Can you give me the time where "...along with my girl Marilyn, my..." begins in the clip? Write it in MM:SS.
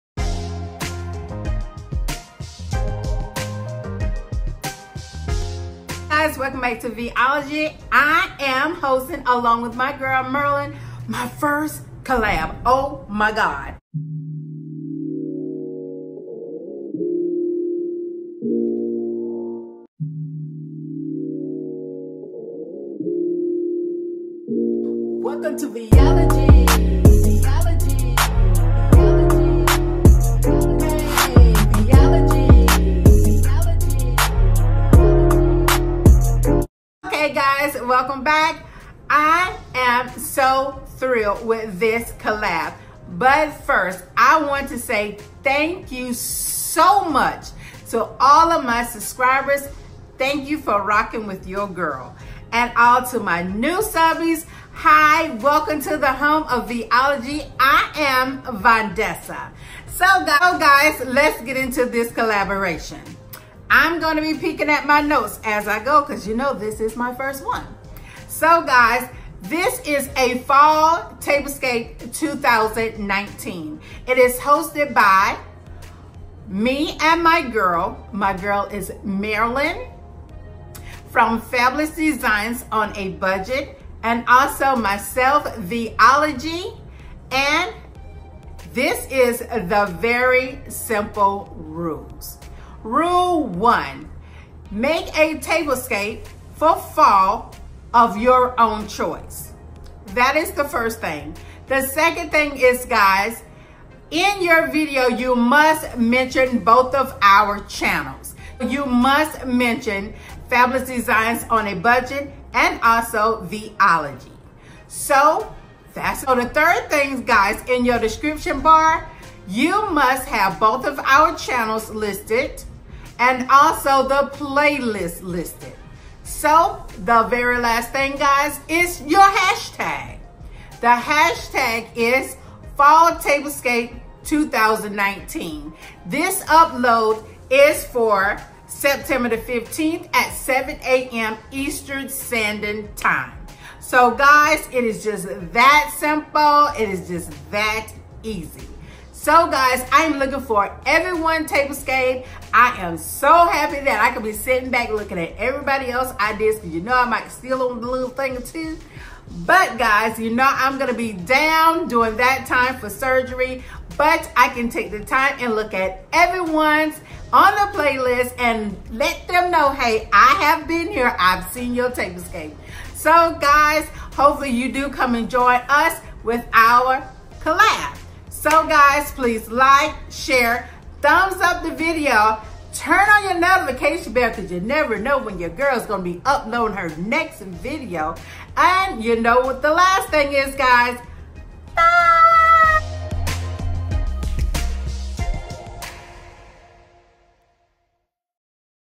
00:09.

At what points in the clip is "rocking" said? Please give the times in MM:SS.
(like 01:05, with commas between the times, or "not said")
00:50.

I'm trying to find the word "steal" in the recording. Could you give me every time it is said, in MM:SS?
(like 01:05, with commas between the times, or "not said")
02:37.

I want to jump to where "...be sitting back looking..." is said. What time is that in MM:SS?
02:34.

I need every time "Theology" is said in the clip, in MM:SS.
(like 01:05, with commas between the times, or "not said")
00:56, 01:25, 01:53.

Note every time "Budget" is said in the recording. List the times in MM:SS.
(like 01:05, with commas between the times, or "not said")
01:23, 01:51.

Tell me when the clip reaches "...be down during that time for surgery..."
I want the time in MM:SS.
02:40.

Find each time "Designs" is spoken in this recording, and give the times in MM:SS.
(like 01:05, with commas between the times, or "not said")
01:21, 01:50.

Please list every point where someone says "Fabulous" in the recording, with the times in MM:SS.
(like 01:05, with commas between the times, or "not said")
01:21, 01:50.